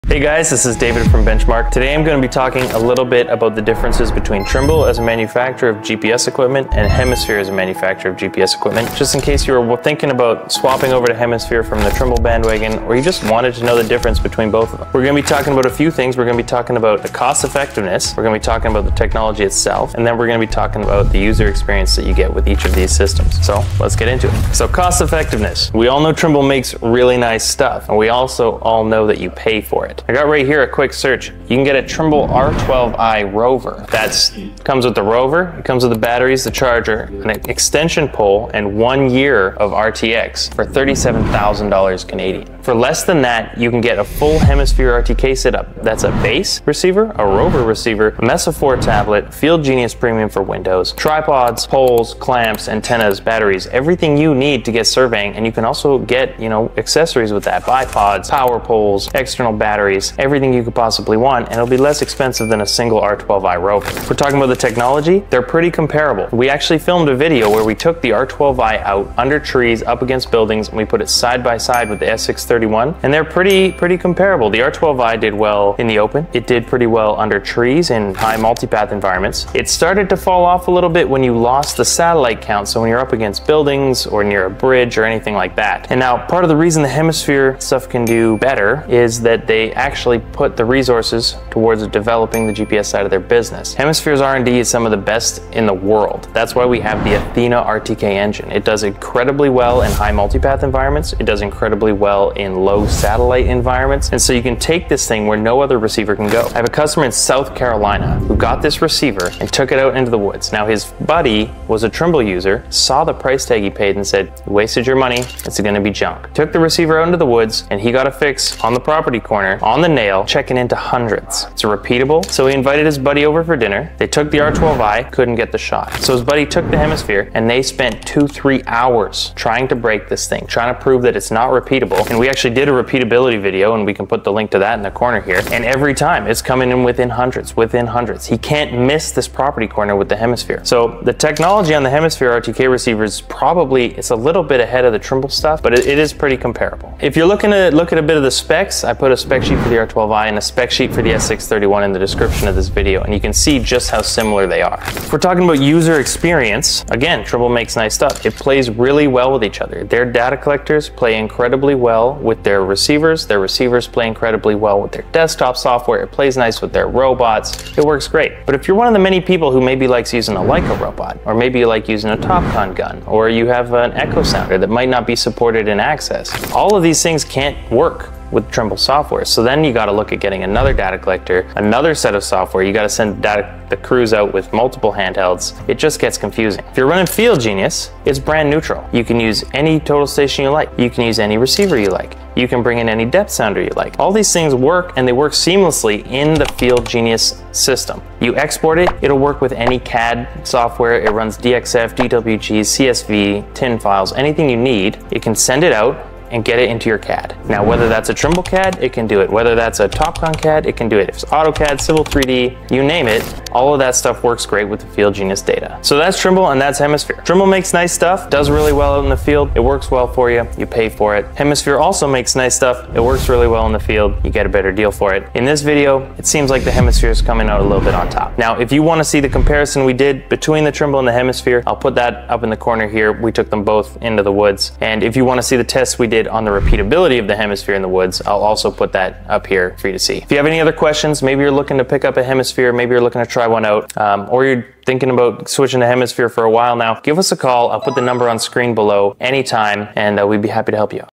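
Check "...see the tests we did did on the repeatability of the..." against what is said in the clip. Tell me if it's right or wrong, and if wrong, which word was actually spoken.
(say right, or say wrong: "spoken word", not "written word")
right.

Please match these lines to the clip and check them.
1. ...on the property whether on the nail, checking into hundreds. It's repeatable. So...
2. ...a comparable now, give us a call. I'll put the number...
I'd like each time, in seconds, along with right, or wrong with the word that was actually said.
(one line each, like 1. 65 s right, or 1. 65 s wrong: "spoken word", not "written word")
1. 118 s wrong: "corner", not "whether"
2. 246 s wrong: "while", not "comparable".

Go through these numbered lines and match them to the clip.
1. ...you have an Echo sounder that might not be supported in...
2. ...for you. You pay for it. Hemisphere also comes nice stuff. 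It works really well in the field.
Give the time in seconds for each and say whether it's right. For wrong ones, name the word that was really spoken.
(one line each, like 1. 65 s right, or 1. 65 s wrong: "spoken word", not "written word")
1. 173 s right
2. 220 s wrong: "makes", not "comes".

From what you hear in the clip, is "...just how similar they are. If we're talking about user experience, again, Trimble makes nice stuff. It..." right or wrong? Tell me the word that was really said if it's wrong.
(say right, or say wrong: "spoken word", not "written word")
right.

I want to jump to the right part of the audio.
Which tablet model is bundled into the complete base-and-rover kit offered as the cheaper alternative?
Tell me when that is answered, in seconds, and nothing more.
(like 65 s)
48 s.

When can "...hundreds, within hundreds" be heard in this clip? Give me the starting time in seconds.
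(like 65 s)
137 s.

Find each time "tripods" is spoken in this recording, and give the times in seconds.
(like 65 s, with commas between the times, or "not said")
50 s.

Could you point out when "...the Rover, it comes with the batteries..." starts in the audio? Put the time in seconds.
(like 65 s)
34 s.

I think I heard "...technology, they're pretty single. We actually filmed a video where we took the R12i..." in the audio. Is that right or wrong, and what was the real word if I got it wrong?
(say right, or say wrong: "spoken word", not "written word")
wrong: "comparable", not "single".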